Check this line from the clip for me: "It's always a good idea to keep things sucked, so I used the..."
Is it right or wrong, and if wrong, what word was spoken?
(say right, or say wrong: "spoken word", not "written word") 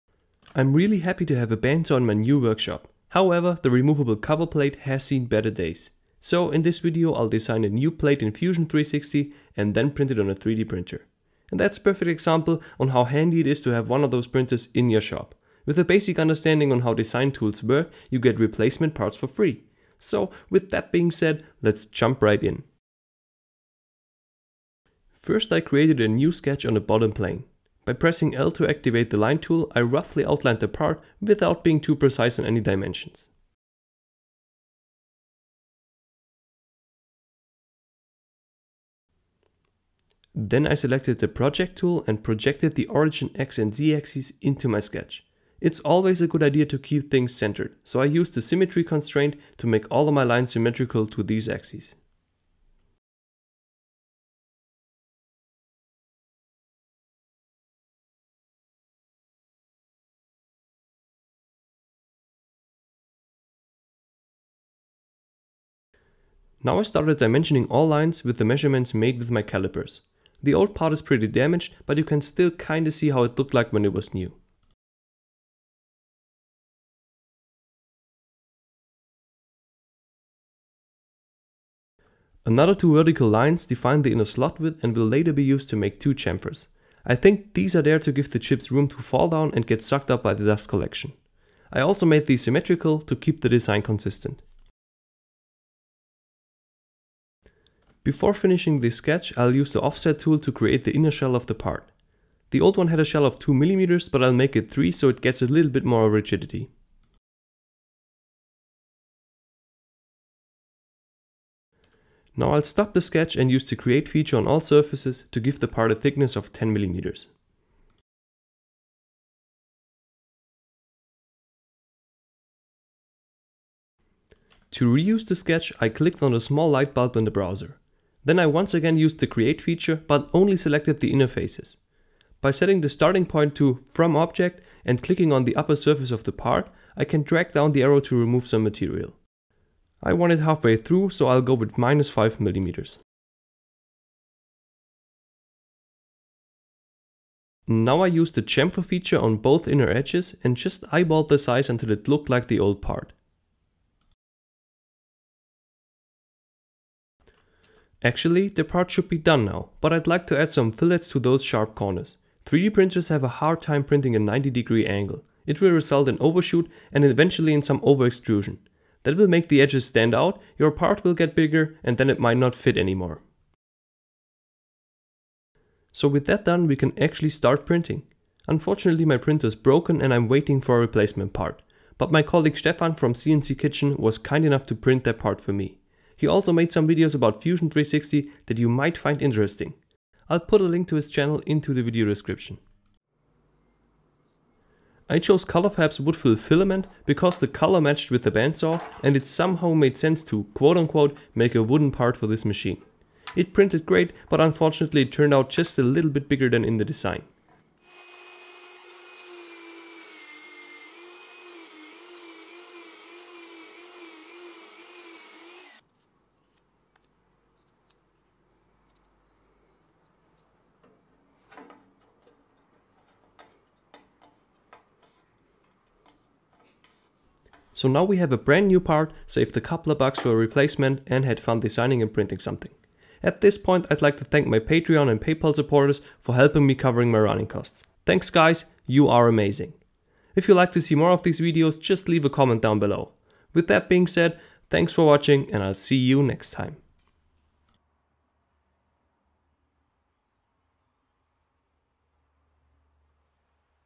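wrong: "centered", not "sucked".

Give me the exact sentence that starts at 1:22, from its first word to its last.
Another two vertical lines define the inner slot width and will later be used to make two chamfers.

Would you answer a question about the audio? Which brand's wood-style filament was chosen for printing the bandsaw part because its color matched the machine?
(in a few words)
ColorFabb.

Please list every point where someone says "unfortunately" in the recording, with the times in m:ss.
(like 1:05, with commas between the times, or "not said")
2:58, 3:24.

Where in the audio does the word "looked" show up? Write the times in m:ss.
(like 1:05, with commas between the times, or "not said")
1:13, 2:32.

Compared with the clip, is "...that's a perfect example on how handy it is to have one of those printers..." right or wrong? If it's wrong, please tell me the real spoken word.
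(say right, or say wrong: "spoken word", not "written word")
right.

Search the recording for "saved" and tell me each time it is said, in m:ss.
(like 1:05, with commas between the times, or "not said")
3:49.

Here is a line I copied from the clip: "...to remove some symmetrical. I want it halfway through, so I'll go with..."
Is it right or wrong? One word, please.
wrong.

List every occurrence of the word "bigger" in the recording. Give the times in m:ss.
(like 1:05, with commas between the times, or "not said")
2:51, 3:26.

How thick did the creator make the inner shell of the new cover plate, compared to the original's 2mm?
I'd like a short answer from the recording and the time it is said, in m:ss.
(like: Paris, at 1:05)
3 mm, at 1:44.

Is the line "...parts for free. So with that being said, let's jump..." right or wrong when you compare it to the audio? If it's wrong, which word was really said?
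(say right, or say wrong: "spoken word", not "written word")
right.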